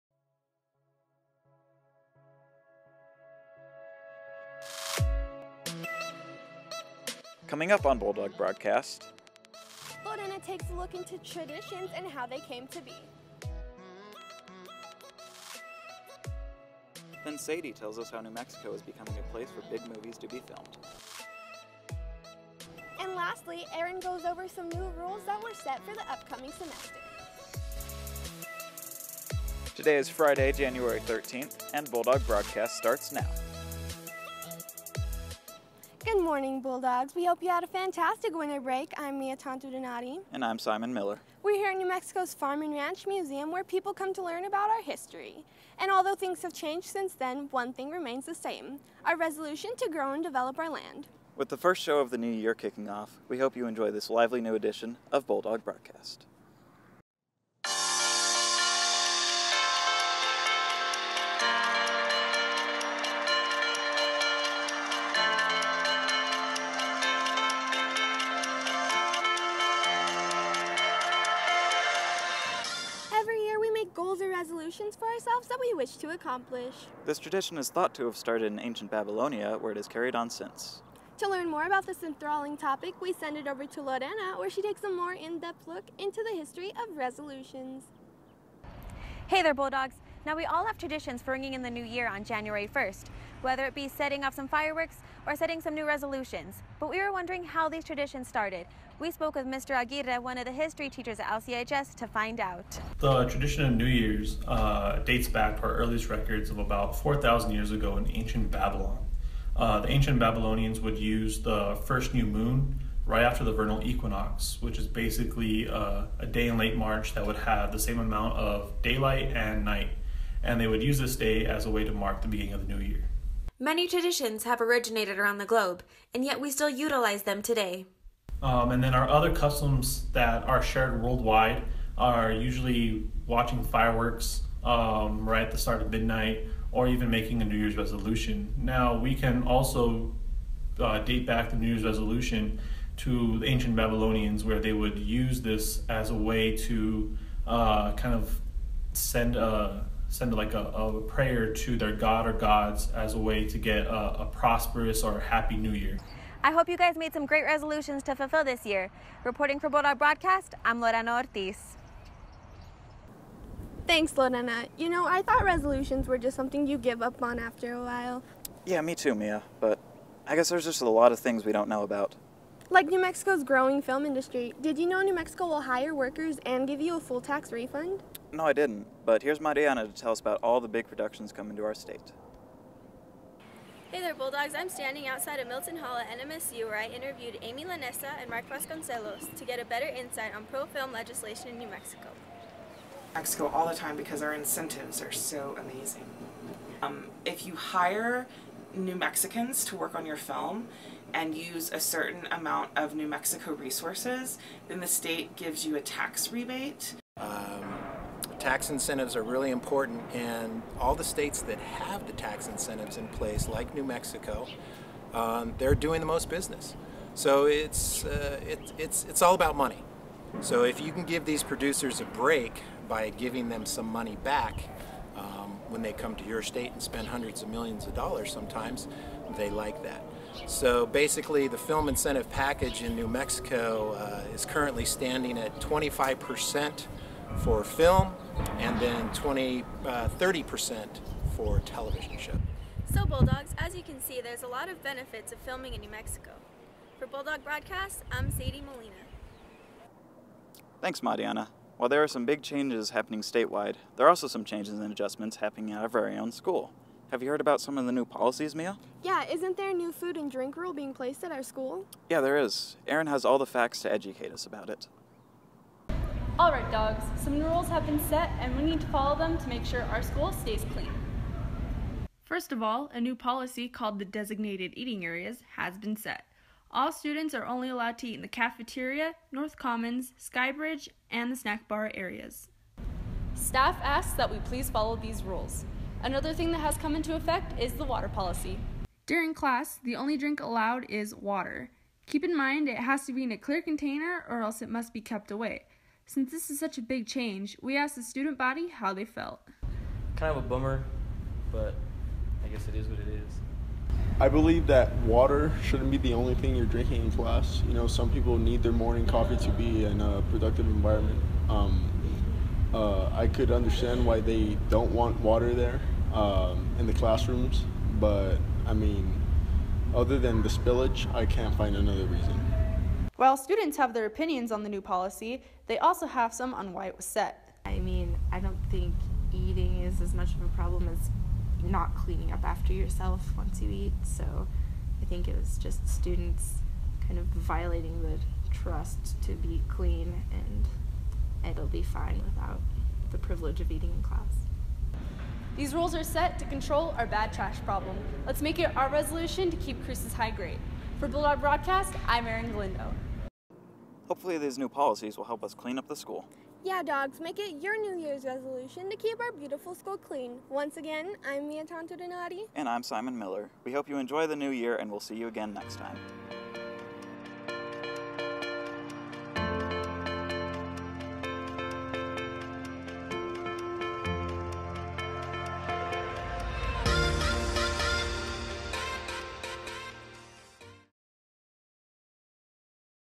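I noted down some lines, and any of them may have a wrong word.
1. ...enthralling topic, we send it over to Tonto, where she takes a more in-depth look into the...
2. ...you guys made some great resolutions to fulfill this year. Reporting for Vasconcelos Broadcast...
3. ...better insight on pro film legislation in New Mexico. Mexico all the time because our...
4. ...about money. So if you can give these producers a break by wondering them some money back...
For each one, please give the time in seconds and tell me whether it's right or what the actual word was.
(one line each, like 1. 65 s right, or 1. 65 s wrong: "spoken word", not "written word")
1. 82 s wrong: "Lorena", not "Tonto"
2. 156 s wrong: "Bulldog", not "Vasconcelos"
3. 189 s right
4. 219 s wrong: "giving", not "wondering".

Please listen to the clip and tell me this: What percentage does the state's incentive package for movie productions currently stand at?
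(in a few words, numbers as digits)
25%.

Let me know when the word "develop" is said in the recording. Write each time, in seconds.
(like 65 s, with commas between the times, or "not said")
50 s.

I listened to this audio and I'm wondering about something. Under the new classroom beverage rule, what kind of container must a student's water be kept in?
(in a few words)
Clear container.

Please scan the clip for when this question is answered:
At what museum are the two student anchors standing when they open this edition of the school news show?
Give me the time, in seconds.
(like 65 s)
41 s.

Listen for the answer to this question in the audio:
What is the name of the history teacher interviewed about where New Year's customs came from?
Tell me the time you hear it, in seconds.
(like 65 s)
99 s.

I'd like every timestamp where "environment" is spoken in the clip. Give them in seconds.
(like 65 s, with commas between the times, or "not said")
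310 s.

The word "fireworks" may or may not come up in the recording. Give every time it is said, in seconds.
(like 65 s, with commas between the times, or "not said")
94 s, 133 s.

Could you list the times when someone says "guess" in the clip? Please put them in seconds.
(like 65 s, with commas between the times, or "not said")
170 s, 302 s.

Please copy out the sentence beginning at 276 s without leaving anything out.
All students are only allowed to eat in the cafeteria, North Commons, Skybridge, and the snack bar areas.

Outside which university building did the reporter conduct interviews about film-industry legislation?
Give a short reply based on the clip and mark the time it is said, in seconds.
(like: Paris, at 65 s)
Milton Hall, at 185 s.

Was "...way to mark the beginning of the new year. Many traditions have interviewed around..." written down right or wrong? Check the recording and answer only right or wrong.
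wrong.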